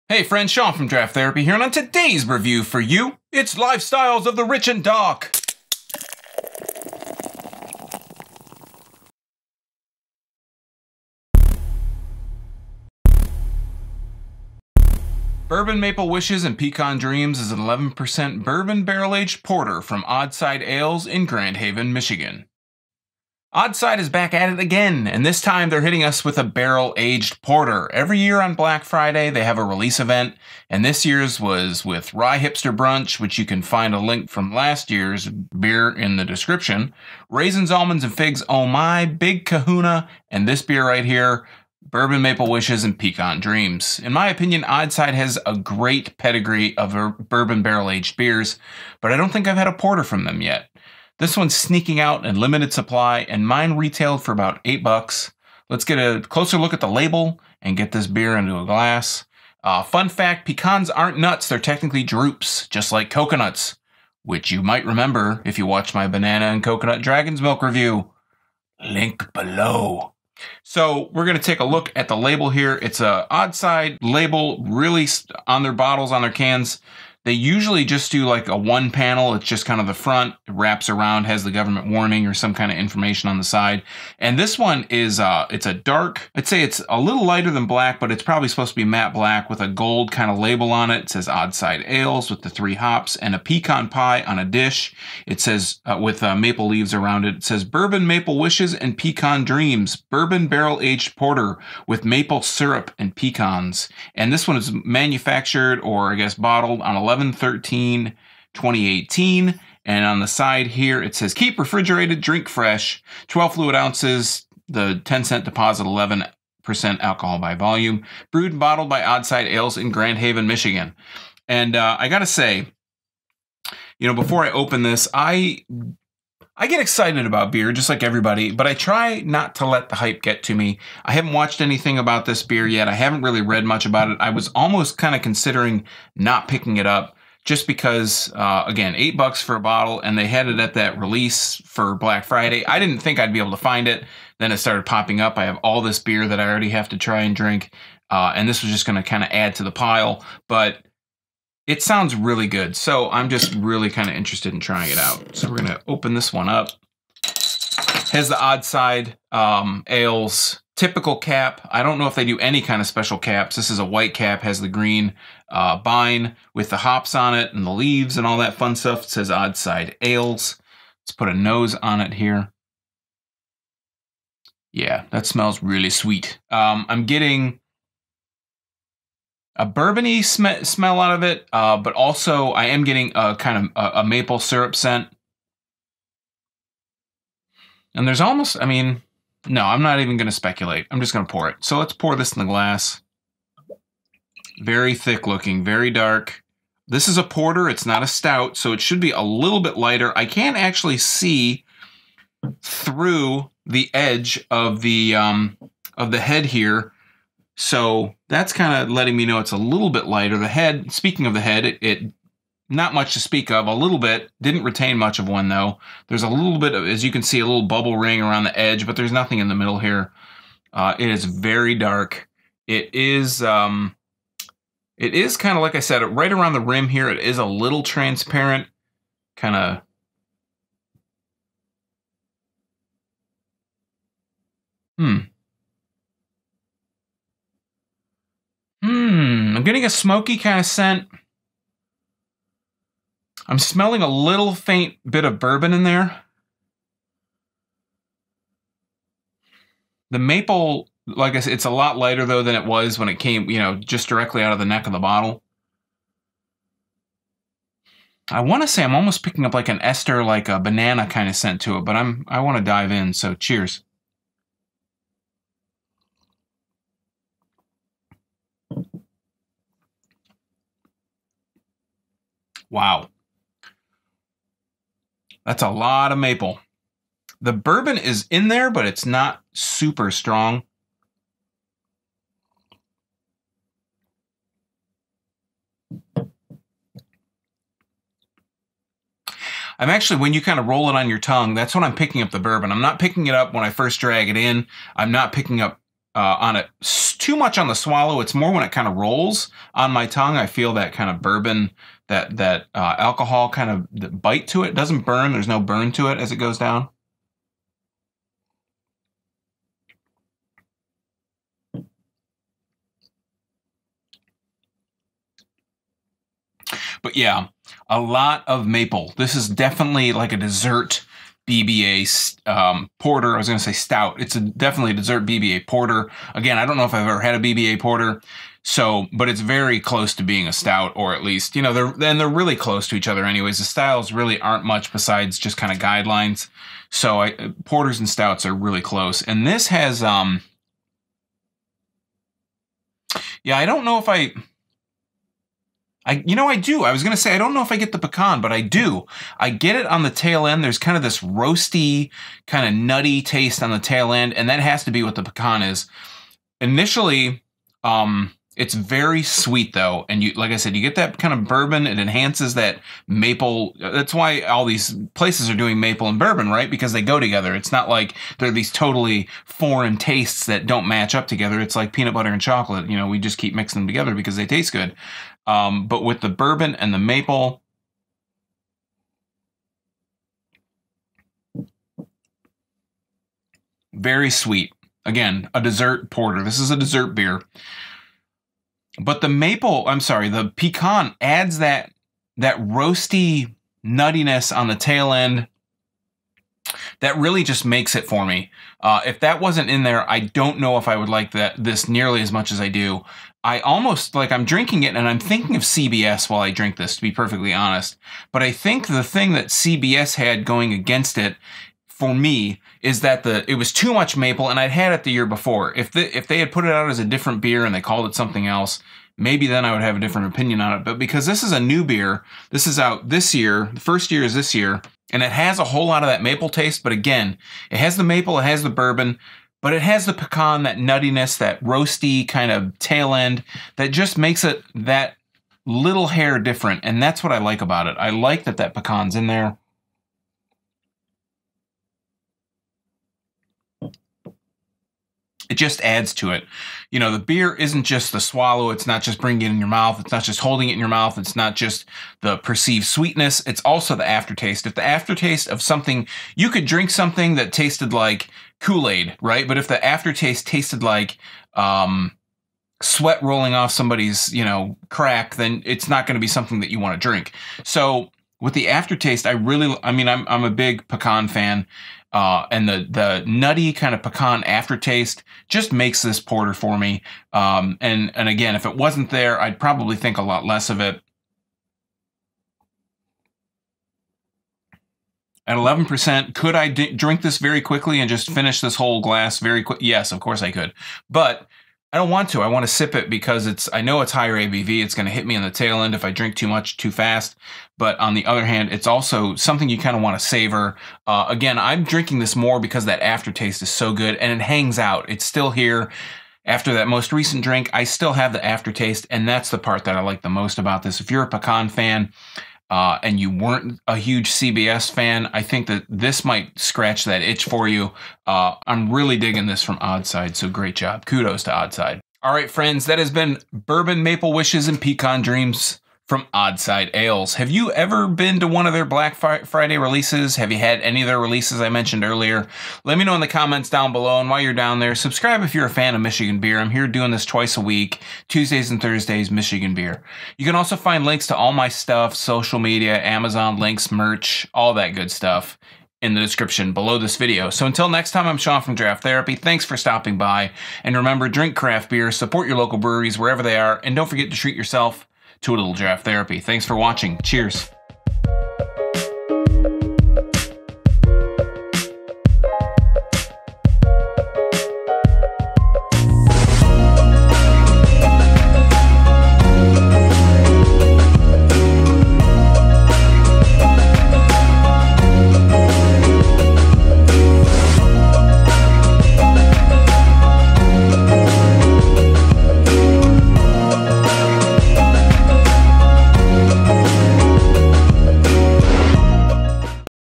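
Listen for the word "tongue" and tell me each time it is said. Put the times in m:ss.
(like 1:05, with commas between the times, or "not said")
4:51, 5:00.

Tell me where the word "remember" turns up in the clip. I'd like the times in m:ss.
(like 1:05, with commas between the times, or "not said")
1:04, 9:10.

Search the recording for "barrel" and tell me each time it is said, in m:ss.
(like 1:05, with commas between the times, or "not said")
0:18, 0:26, 0:47, 1:40.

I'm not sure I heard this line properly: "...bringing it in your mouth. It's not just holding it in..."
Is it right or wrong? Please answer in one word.
right.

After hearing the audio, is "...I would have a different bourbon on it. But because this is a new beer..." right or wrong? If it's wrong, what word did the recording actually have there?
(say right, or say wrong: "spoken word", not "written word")
wrong: "opinion", not "bourbon".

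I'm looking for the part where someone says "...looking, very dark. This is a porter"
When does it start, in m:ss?
3:15.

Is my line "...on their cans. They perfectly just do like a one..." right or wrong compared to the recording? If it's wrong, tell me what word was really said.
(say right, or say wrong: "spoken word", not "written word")
wrong: "usually", not "perfectly".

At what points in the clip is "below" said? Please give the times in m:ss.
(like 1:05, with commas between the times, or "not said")
1:09, 8:53, 9:06.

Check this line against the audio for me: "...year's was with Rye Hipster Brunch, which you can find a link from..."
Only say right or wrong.
right.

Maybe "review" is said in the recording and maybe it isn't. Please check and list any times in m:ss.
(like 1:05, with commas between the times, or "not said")
0:02, 1:07.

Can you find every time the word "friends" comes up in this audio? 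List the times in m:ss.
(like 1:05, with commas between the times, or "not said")
0:00, 8:42.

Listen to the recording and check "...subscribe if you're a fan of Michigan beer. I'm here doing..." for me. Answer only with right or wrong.
right.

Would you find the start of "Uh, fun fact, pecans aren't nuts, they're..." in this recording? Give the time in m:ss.
0:59.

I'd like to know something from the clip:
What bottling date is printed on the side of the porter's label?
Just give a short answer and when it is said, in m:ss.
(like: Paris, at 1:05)
11/13/2018, at 1:47.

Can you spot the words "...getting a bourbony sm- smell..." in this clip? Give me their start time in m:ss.
2:57.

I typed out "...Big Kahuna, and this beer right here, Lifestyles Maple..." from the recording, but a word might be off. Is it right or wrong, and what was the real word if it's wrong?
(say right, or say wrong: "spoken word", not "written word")
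wrong: "Bourbon", not "Lifestyles".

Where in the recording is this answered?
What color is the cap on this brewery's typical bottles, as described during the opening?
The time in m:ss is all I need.
2:43.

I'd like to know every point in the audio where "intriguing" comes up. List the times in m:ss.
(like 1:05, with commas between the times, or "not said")
not said.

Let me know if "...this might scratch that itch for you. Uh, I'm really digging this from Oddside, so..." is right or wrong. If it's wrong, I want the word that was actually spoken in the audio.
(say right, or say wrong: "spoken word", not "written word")
right.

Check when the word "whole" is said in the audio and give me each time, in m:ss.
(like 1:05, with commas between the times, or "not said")
7:05, 8:08.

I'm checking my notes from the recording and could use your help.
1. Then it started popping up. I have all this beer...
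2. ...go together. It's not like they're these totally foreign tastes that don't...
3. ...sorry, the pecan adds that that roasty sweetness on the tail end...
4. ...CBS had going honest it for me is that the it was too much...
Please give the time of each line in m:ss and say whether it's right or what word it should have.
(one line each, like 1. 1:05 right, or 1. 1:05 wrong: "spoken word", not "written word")
1. 2:24 right
2. 6:07 right
3. 6:29 wrong: "nuttiness", not "sweetness"
4. 6:49 wrong: "against", not "honest".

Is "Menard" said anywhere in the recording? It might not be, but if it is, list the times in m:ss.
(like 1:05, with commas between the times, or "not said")
not said.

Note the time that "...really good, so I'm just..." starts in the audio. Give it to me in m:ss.
2:32.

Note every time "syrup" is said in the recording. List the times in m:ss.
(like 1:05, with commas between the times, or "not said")
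1:42, 3:04.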